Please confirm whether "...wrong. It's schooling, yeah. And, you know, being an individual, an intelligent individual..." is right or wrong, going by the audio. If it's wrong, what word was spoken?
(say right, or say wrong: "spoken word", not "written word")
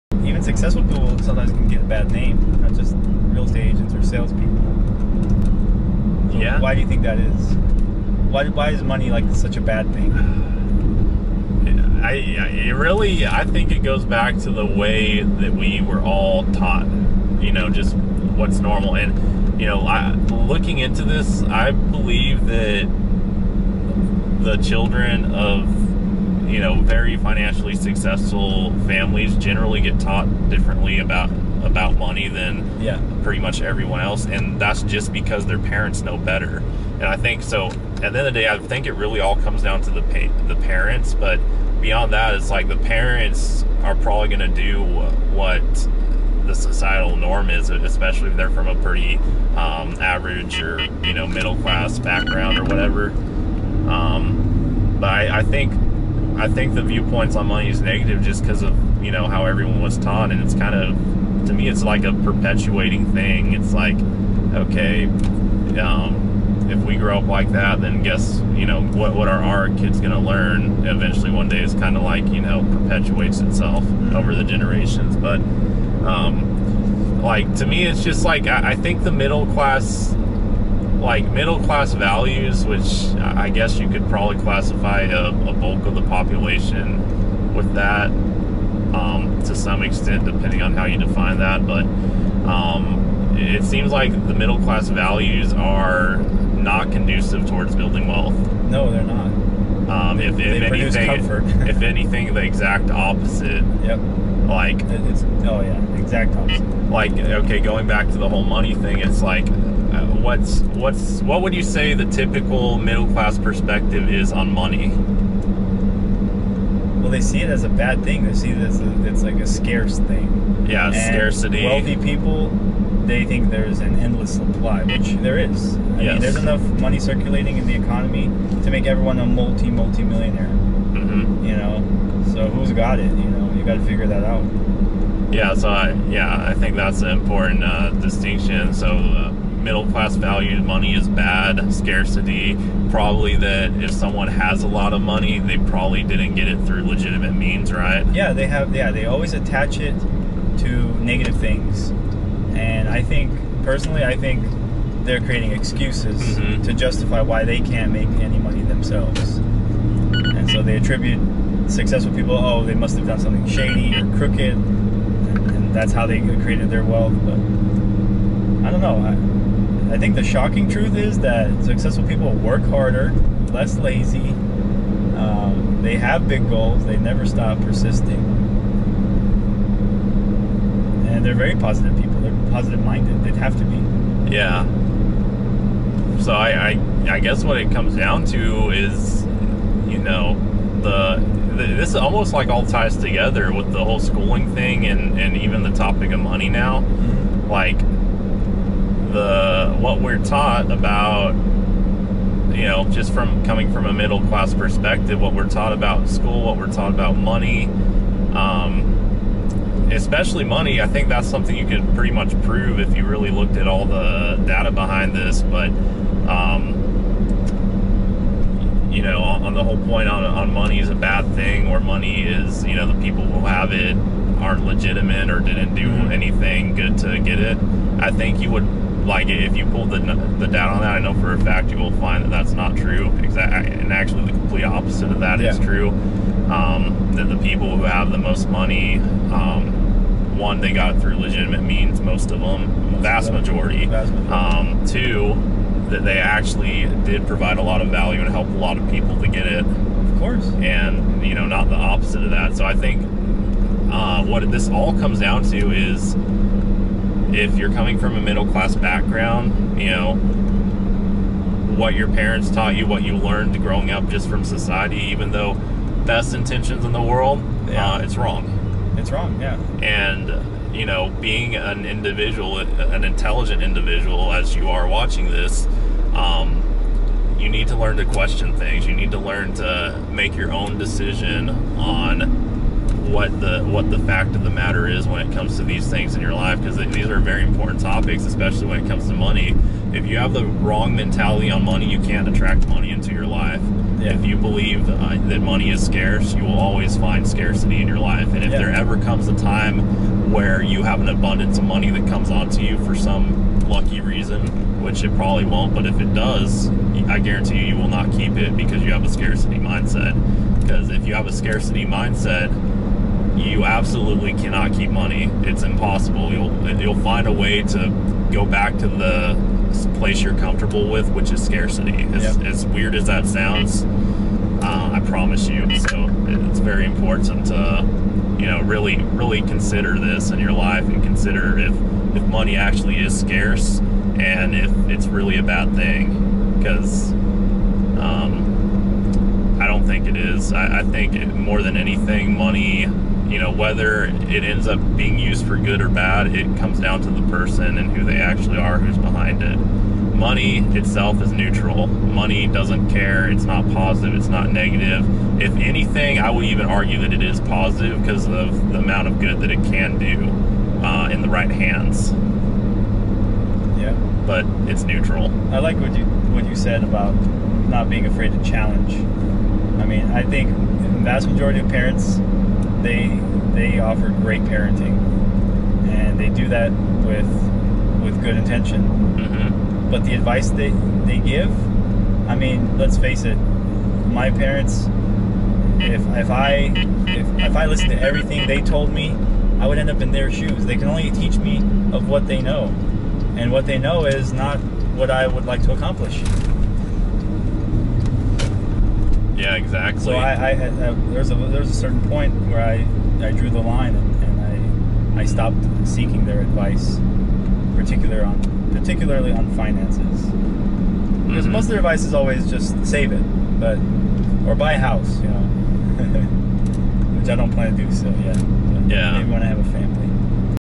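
wrong: "wrong", not "schooling".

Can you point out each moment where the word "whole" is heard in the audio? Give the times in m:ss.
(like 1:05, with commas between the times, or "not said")
1:48, 3:13, 3:39.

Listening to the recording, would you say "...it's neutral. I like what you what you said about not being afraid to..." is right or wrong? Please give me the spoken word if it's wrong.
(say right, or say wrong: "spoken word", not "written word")
right.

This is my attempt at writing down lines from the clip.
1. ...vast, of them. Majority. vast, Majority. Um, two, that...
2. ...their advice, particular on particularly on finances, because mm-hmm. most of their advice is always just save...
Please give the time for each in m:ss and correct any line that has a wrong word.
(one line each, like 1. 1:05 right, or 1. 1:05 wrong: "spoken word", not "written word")
1. 4:03 right
2. 6:46 right.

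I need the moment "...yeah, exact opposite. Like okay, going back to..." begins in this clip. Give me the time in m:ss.
1:45.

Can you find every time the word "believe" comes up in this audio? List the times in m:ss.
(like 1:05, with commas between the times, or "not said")
0:21, 4:54.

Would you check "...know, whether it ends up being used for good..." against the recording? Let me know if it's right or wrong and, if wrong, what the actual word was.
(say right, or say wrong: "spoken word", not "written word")
right.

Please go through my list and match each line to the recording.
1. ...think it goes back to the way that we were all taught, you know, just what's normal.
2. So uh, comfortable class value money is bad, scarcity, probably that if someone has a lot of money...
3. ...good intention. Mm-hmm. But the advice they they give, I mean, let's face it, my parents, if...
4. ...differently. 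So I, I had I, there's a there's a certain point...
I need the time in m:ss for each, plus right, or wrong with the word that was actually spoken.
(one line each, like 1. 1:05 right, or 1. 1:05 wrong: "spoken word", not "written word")
1. 0:13 right
2. 2:18 wrong: "middle", not "comfortable"
3. 6:18 right
4. 6:39 wrong: "exactly", not "differently".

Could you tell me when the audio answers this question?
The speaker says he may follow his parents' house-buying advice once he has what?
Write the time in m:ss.
6:59.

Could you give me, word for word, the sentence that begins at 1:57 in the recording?
Well, they see it as a bad thing.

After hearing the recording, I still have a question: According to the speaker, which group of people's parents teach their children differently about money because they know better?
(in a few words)
Very financially successful families.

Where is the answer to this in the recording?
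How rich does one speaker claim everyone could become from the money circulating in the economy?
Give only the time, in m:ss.
2:09.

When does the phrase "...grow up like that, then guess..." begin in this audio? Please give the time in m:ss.
1:06.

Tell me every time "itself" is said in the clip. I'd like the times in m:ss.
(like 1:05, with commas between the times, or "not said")
1:13, 5:50.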